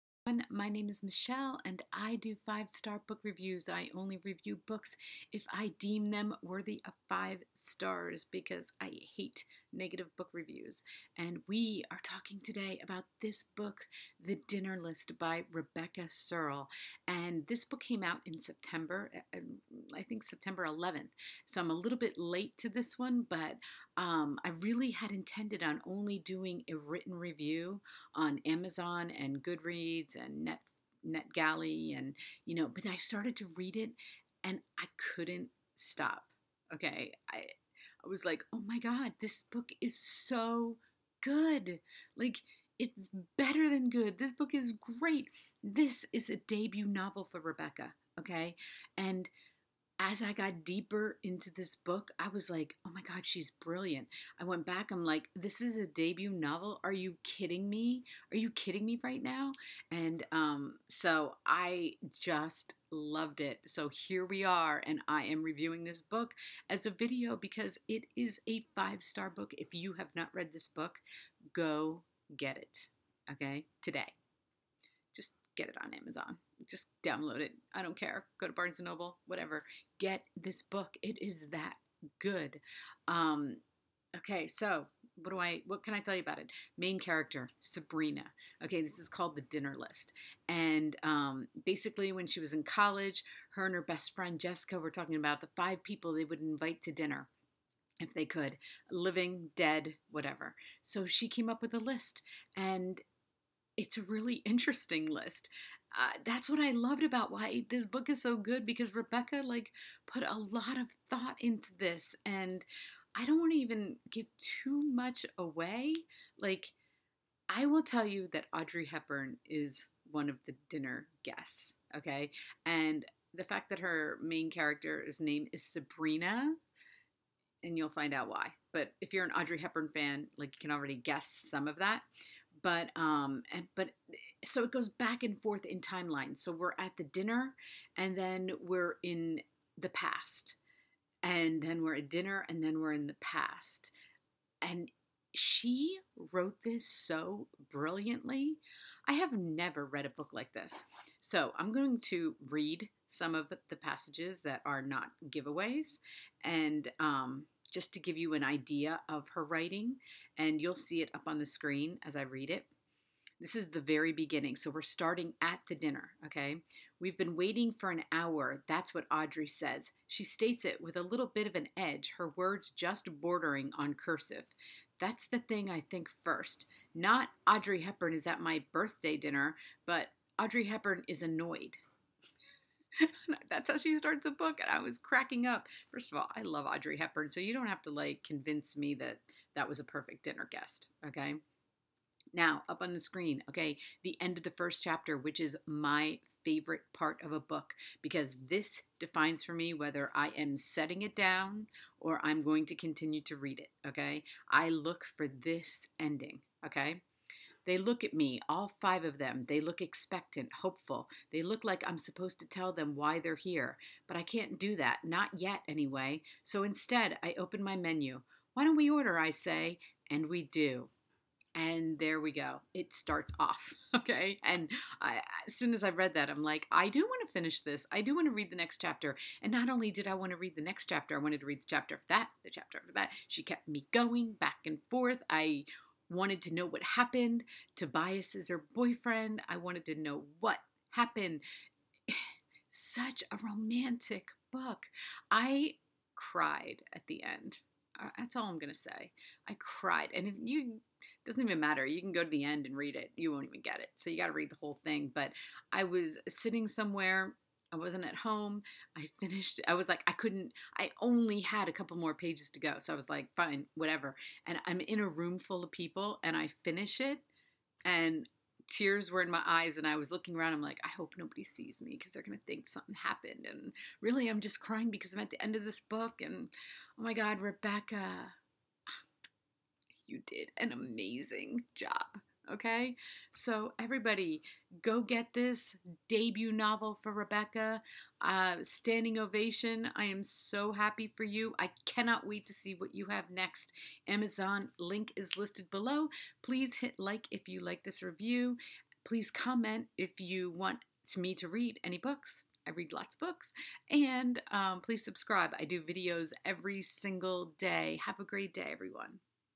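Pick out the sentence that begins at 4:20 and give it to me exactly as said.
I only had a couple more pages to go.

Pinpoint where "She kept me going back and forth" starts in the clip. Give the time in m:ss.
3:53.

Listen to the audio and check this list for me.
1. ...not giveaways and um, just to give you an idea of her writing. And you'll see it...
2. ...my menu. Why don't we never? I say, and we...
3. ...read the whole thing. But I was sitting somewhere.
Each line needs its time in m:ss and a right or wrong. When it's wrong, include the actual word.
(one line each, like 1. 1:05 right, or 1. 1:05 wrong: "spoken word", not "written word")
1. 2:34 right
2. 3:37 wrong: "order", not "never"
3. 4:14 right.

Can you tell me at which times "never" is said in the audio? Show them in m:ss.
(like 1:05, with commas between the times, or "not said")
2:29.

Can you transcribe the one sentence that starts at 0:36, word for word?
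Okay, I I was like, oh my God, this book is so good.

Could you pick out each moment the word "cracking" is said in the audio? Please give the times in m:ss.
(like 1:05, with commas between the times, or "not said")
3:04.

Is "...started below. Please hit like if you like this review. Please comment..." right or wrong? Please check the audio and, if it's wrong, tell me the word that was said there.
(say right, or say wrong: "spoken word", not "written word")
wrong: "listed", not "started".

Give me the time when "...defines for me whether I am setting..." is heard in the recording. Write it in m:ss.
3:18.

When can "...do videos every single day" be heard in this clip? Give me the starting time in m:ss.
5:05.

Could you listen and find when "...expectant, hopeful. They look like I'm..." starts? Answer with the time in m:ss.
3:29.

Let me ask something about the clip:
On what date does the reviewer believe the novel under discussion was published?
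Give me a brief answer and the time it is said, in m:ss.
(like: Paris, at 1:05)
September 11, at 0:20.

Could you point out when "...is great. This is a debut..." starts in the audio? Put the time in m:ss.
0:44.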